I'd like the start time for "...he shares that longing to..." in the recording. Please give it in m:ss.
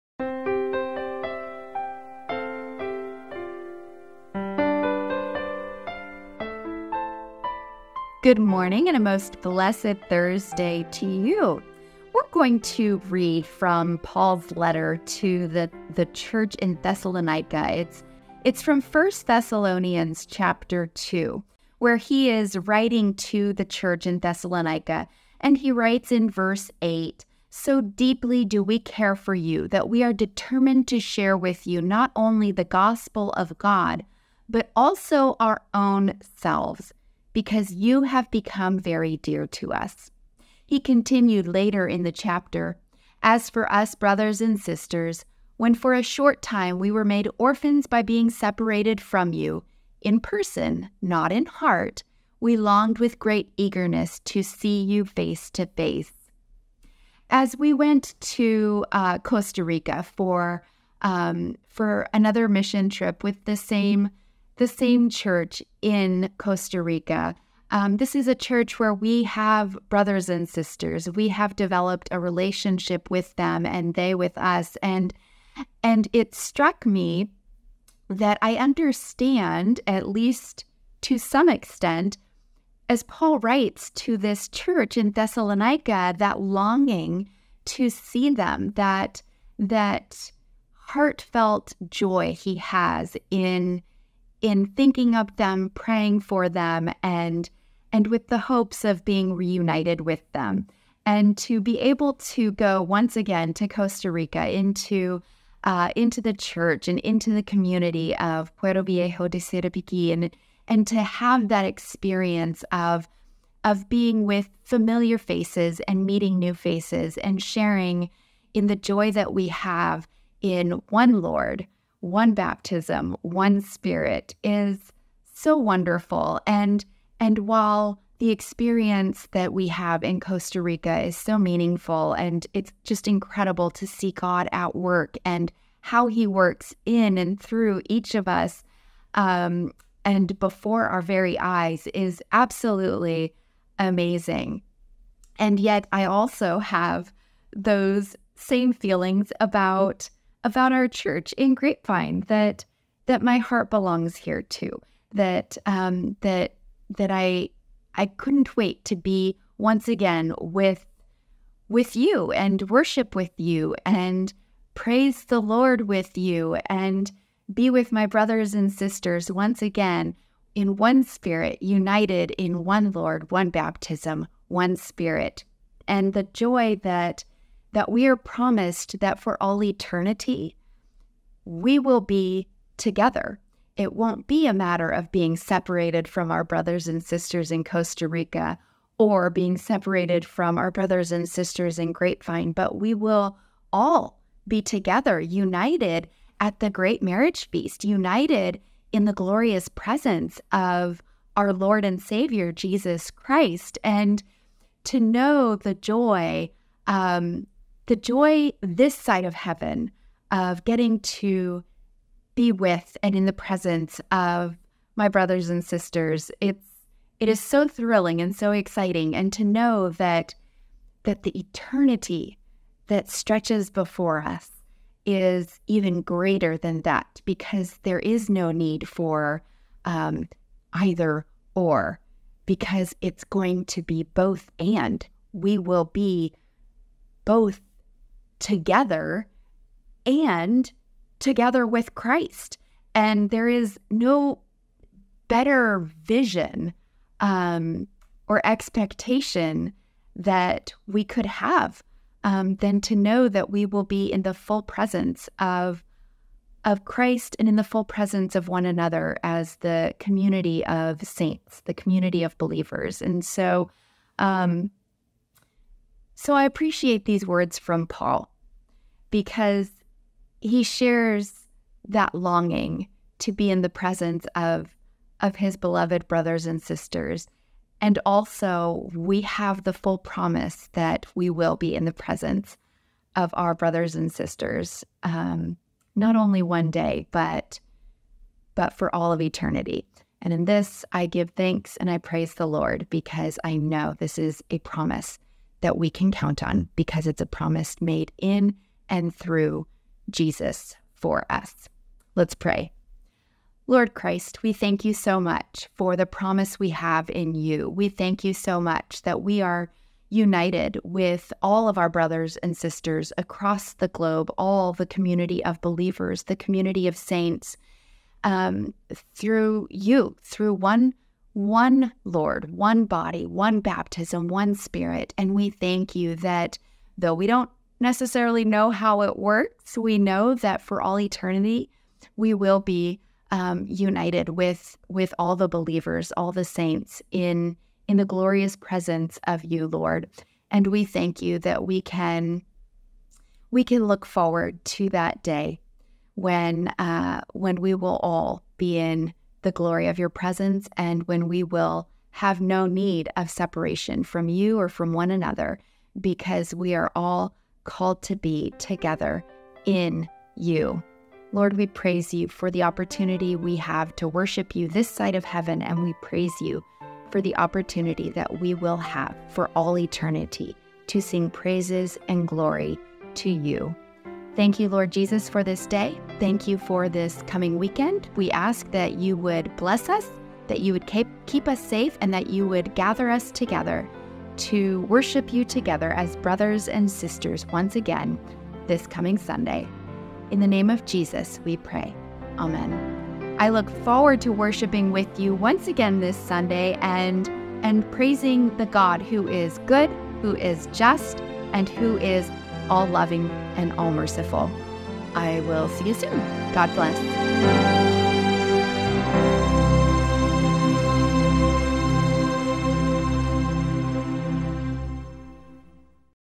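4:30.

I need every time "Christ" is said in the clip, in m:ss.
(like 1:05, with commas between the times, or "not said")
3:23, 4:01, 4:16, 5:03.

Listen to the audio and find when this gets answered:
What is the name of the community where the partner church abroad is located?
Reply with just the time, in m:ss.
1:48.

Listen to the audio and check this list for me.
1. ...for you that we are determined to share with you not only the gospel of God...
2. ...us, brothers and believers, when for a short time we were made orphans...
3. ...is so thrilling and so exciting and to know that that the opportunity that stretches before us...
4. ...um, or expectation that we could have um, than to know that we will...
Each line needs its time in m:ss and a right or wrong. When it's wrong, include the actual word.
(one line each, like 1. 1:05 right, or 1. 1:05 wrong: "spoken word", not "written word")
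1. 0:29 right
2. 0:43 wrong: "sisters", not "believers"
3. 3:37 wrong: "eternity", not "opportunity"
4. 4:07 right.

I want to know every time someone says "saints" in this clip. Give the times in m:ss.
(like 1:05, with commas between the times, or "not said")
4:21, 5:16, 5:36.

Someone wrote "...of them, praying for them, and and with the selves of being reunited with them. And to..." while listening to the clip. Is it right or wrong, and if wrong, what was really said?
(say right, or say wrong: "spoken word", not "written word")
wrong: "hopes", not "selves".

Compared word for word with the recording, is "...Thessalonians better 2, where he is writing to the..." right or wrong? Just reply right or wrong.
wrong.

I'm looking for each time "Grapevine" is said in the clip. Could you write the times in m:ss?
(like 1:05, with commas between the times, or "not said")
2:31, 3:11.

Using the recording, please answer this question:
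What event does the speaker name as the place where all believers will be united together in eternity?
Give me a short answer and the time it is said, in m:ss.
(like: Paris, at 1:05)
the great marriage feast, at 3:16.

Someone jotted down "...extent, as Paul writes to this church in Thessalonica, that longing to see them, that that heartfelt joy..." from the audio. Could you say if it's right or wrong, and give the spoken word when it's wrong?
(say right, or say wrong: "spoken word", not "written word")
right.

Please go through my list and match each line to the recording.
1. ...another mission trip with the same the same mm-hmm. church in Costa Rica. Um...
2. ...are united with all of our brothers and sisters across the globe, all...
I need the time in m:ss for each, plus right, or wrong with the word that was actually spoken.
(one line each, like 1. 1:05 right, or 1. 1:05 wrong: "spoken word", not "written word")
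1. 1:02 right
2. 5:09 right.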